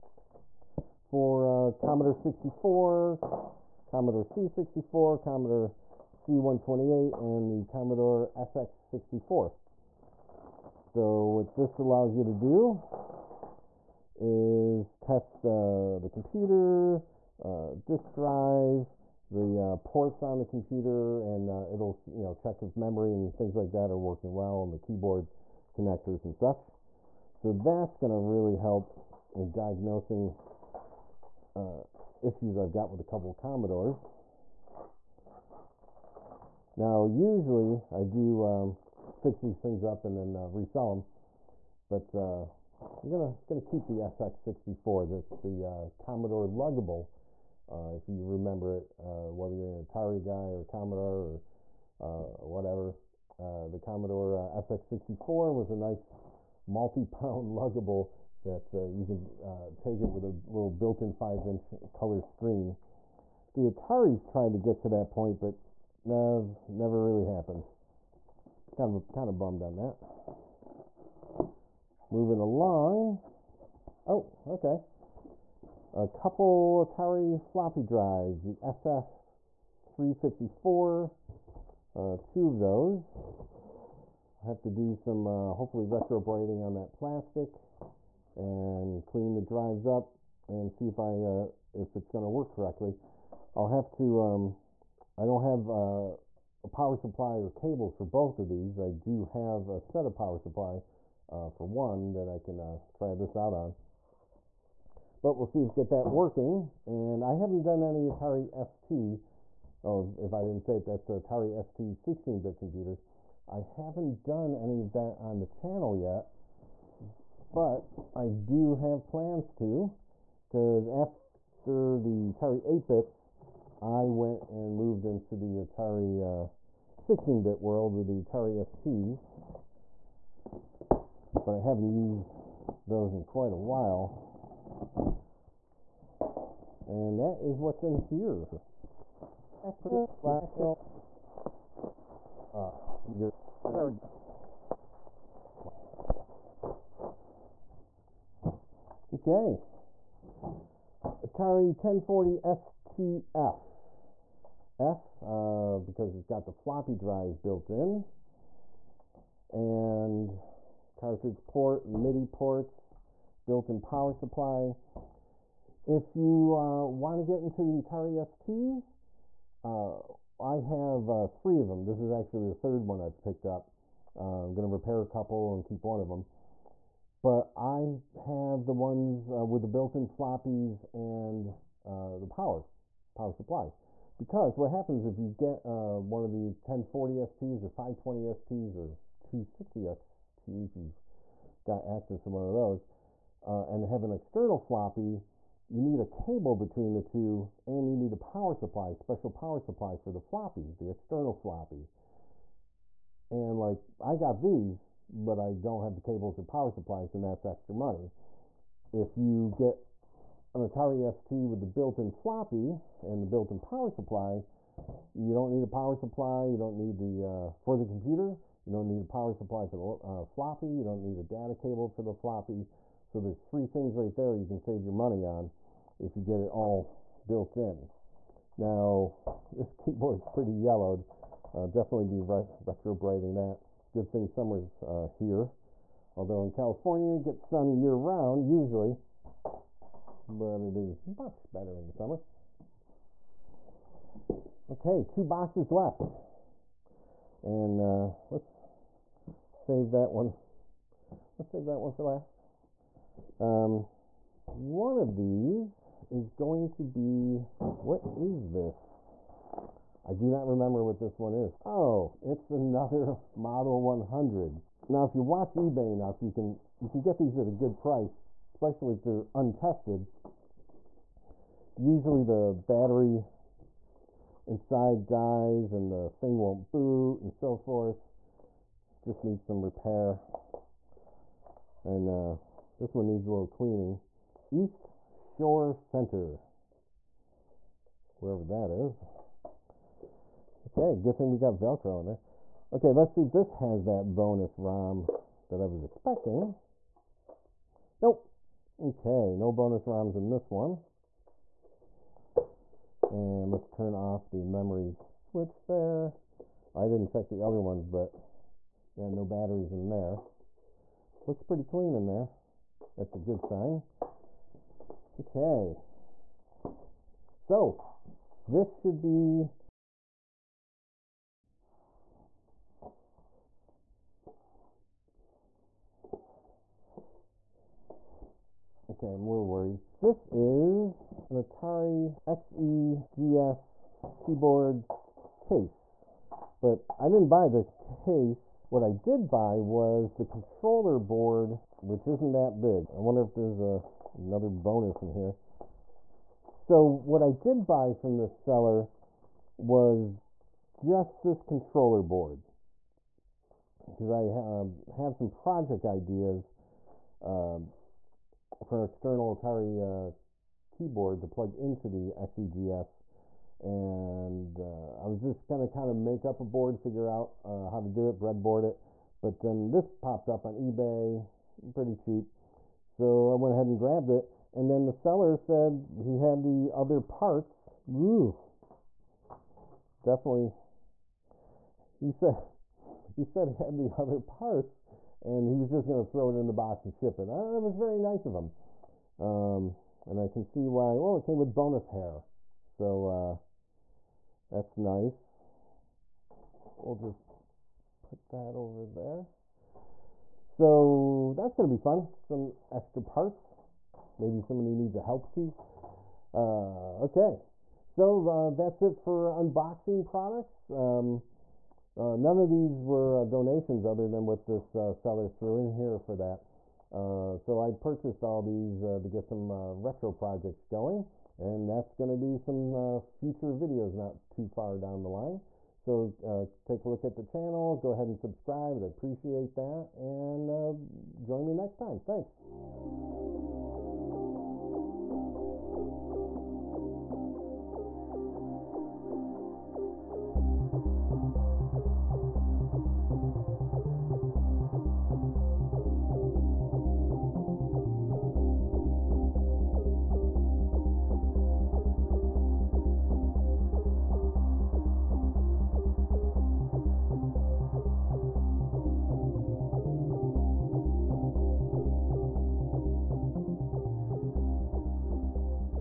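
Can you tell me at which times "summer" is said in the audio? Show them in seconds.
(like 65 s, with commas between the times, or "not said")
234 s, 241 s.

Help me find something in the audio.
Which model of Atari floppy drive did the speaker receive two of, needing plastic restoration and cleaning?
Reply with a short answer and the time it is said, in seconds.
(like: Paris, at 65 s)
SF354, at 78 s.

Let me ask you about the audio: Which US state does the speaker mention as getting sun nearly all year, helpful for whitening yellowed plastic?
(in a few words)
California.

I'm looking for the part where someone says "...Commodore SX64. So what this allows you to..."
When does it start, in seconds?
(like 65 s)
7 s.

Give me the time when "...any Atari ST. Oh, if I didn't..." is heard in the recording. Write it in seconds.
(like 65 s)
107 s.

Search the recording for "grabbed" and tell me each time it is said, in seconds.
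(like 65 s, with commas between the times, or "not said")
373 s.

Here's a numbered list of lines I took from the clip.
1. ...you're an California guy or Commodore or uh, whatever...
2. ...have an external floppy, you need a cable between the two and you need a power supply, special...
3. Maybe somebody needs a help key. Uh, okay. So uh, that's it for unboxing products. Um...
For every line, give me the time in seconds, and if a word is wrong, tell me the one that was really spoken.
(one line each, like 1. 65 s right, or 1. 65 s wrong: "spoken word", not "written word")
1. 49 s wrong: "Atari", not "California"
2. 193 s right
3. 404 s right.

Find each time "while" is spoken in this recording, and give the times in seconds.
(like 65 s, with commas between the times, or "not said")
133 s.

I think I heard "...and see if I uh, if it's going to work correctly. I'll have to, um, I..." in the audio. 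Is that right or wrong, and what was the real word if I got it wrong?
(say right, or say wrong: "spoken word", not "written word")
right.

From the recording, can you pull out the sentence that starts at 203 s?
And like I got these, but I don't have the cables or power supplies and that's extra money.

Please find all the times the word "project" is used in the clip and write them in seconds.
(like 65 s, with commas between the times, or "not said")
355 s, 420 s.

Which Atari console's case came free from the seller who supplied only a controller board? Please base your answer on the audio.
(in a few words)
Atari XEGS.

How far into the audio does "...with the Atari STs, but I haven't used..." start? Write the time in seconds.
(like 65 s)
127 s.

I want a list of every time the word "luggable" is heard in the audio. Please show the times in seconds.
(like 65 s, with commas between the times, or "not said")
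46 s, 57 s.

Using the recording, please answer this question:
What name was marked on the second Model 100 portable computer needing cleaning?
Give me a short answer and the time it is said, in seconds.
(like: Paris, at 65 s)
East Shore Center, at 284 s.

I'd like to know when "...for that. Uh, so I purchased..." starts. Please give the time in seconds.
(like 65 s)
415 s.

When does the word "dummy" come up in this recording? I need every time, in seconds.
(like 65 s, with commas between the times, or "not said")
not said.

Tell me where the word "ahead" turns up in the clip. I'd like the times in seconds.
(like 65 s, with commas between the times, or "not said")
373 s, 427 s.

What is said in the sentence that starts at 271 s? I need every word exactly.
Usually the battery inside dies and the thing won't boot and so forth.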